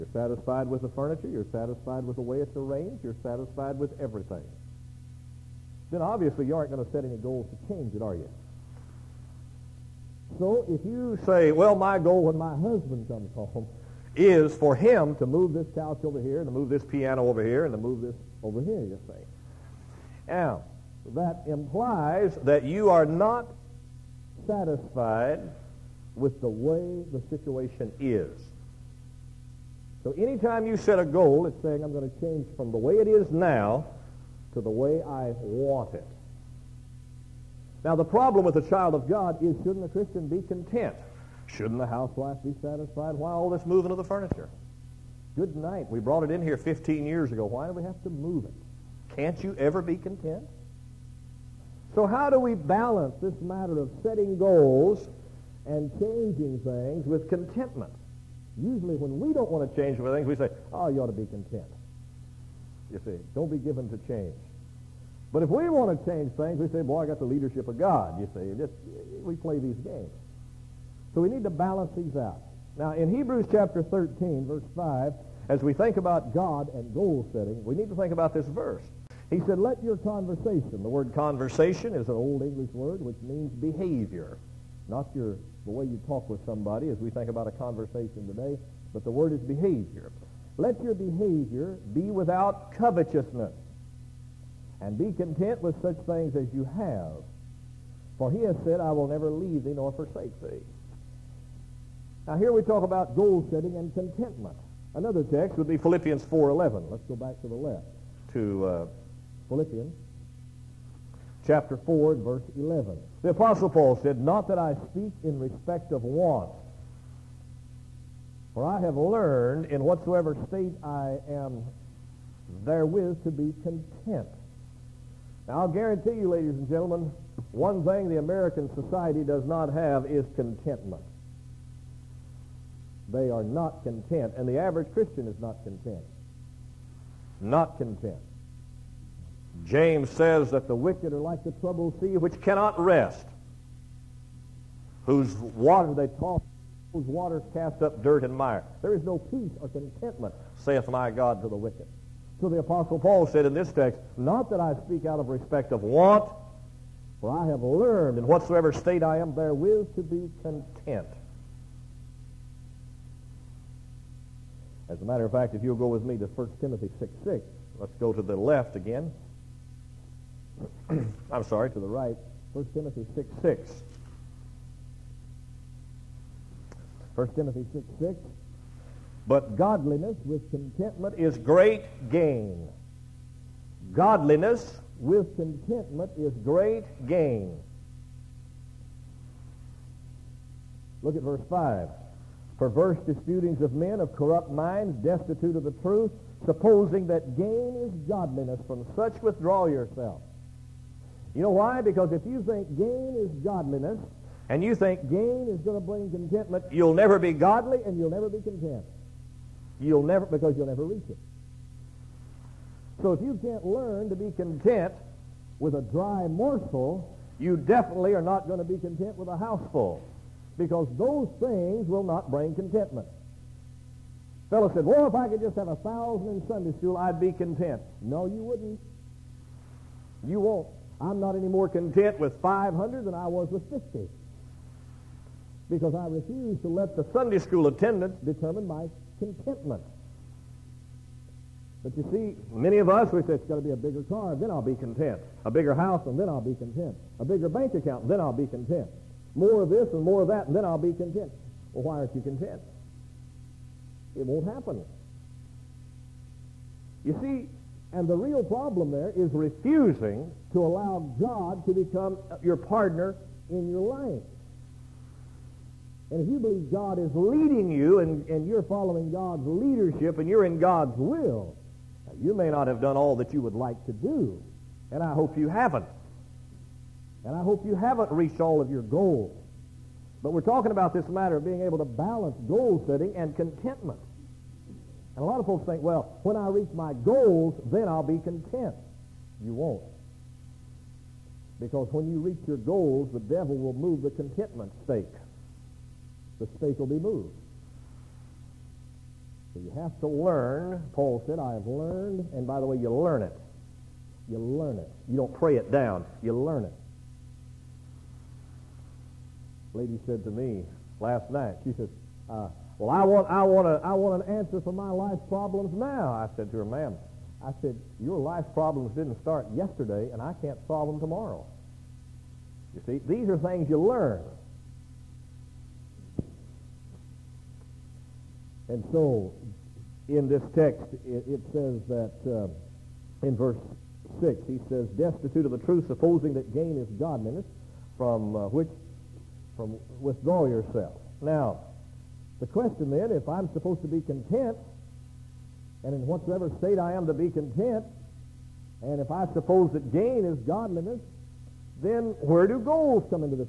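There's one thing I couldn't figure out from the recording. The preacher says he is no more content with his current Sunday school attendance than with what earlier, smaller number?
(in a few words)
50.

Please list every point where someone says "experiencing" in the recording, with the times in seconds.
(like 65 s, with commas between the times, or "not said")
not said.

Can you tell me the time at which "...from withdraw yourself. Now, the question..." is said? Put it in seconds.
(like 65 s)
339 s.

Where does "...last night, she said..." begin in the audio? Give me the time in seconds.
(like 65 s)
311 s.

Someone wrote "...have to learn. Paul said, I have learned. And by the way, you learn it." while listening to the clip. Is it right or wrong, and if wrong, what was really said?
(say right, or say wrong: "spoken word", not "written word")
right.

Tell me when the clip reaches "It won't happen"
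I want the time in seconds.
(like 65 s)
254 s.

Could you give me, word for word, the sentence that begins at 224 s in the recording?
Fellow said, well, if I could just have a thousand in Sunday school, I'd be content.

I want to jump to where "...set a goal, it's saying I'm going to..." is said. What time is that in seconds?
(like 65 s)
30 s.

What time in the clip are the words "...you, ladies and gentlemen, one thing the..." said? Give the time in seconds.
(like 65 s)
126 s.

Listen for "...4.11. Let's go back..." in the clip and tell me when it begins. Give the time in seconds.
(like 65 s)
106 s.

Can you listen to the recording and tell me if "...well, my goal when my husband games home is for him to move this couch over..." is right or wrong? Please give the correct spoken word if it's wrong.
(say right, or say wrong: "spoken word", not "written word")
wrong: "comes", not "games".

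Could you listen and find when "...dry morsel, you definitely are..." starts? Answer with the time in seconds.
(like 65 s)
215 s.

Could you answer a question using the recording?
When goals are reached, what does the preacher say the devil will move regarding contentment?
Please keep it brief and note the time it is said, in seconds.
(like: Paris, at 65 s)
the contentment stake, at 294 s.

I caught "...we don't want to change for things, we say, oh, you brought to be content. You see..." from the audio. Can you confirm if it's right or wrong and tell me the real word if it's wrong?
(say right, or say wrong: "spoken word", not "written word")
wrong: "ought", not "brought".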